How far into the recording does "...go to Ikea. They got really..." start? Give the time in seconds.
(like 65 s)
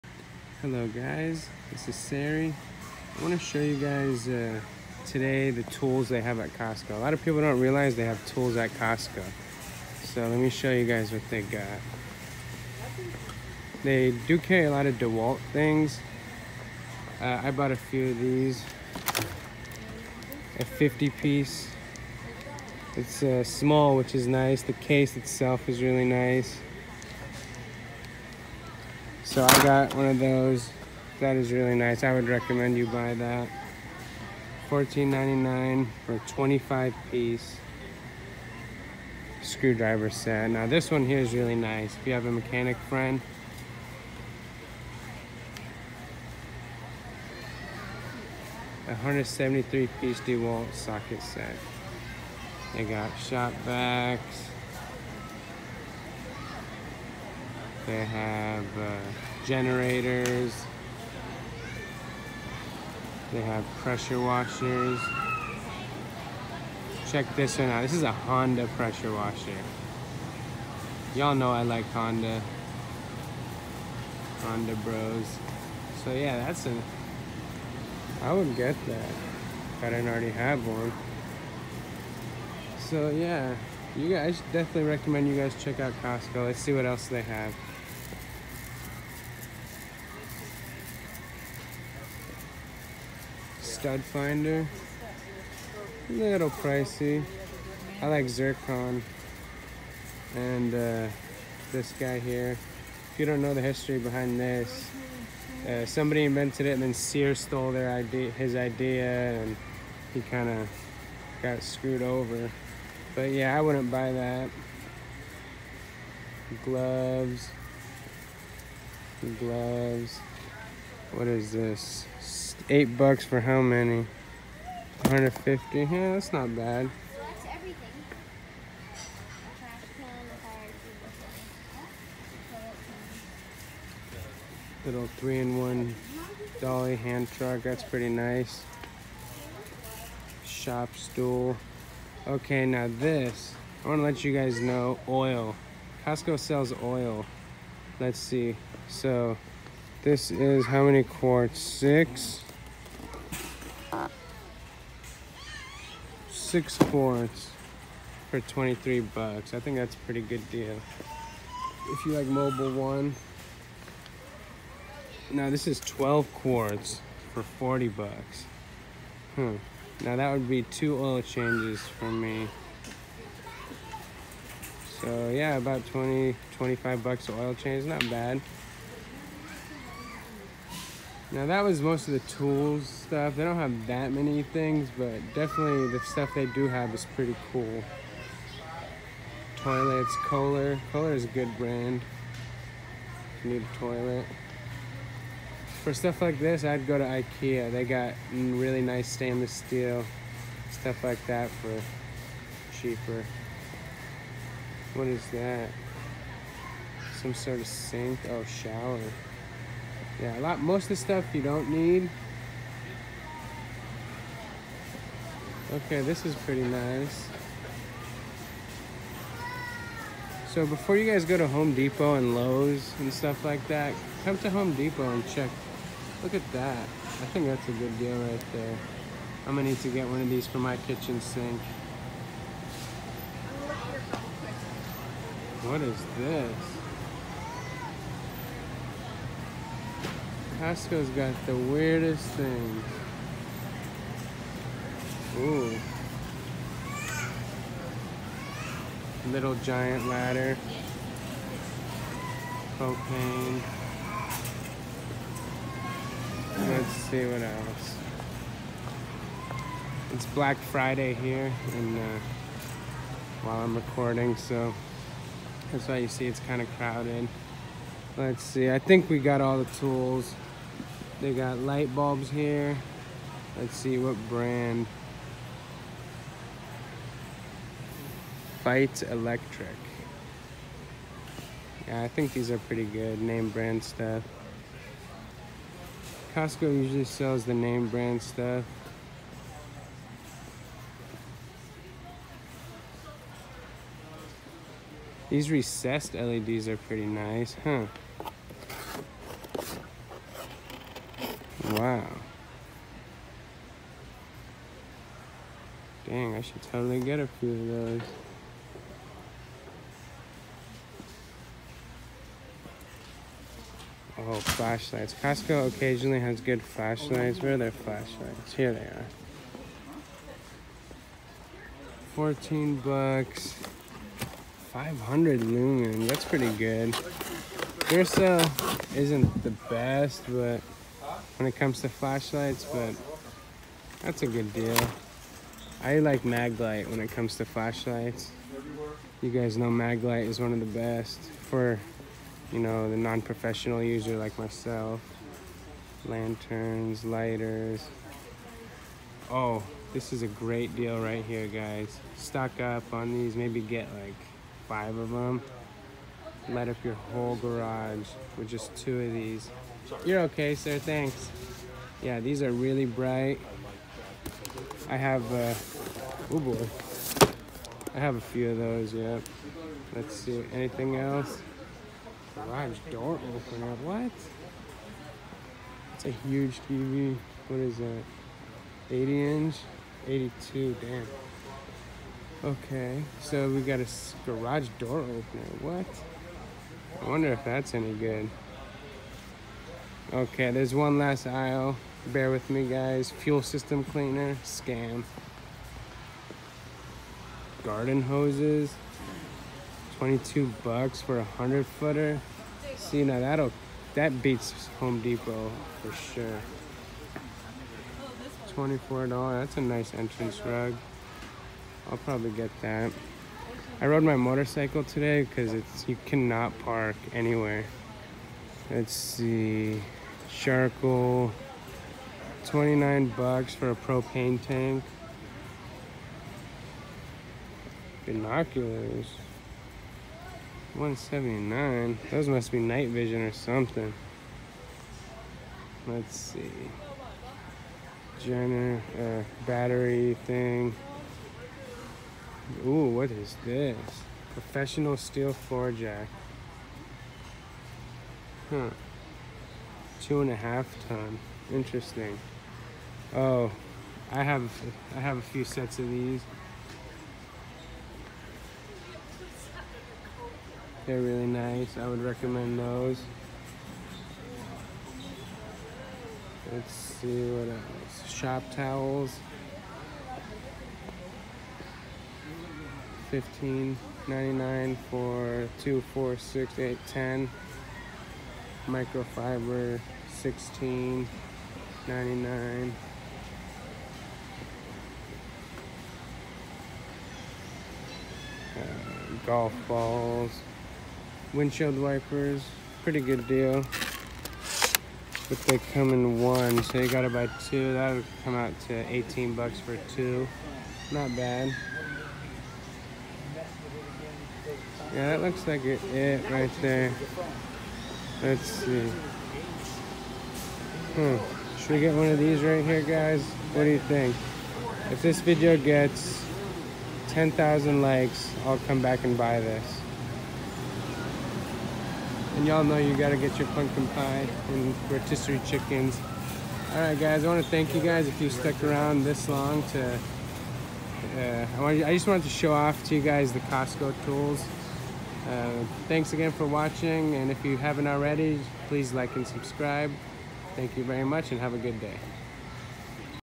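196 s.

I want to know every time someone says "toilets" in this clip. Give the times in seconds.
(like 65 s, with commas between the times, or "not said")
189 s, 193 s.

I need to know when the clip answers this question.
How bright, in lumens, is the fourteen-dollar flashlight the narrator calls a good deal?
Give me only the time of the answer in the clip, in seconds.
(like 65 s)
324 s.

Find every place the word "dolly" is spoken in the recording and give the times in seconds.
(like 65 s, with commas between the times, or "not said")
136 s.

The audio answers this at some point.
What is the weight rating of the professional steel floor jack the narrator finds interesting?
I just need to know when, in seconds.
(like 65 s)
449 s.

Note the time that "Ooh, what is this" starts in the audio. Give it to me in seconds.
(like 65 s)
442 s.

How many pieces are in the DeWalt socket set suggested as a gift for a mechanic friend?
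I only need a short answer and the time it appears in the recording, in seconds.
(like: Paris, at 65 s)
173, at 48 s.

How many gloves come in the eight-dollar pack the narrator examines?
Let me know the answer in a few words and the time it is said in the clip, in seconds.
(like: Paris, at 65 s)
150, at 125 s.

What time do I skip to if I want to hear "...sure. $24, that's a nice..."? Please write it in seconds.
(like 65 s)
405 s.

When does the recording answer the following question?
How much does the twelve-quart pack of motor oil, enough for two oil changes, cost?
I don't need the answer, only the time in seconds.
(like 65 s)
167 s.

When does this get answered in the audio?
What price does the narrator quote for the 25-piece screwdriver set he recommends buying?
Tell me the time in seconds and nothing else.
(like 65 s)
34 s.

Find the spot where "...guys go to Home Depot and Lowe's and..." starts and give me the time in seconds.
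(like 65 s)
221 s.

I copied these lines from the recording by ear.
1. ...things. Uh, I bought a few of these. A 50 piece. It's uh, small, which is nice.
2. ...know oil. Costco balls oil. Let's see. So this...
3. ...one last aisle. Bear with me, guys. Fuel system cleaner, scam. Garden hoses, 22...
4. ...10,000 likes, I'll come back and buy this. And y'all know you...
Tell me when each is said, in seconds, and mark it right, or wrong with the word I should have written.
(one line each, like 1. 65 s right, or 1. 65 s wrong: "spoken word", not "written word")
1. 15 s right
2. 144 s wrong: "sells", not "balls"
3. 390 s right
4. 517 s right.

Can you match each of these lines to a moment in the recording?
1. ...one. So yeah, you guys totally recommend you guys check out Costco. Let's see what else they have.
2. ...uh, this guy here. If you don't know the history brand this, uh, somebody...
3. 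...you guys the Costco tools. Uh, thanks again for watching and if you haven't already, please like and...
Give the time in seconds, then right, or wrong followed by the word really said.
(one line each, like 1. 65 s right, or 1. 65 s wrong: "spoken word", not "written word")
1. 80 s wrong: "definitely", not "totally"
2. 100 s wrong: "behind", not "brand"
3. 532 s right.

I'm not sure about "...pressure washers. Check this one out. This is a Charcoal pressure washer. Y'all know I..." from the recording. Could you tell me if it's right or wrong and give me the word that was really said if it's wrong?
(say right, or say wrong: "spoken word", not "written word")
wrong: "Honda", not "Charcoal".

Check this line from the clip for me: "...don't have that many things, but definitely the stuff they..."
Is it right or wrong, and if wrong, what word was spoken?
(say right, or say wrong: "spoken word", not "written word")
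right.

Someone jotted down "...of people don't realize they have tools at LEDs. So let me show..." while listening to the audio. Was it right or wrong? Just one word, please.
wrong.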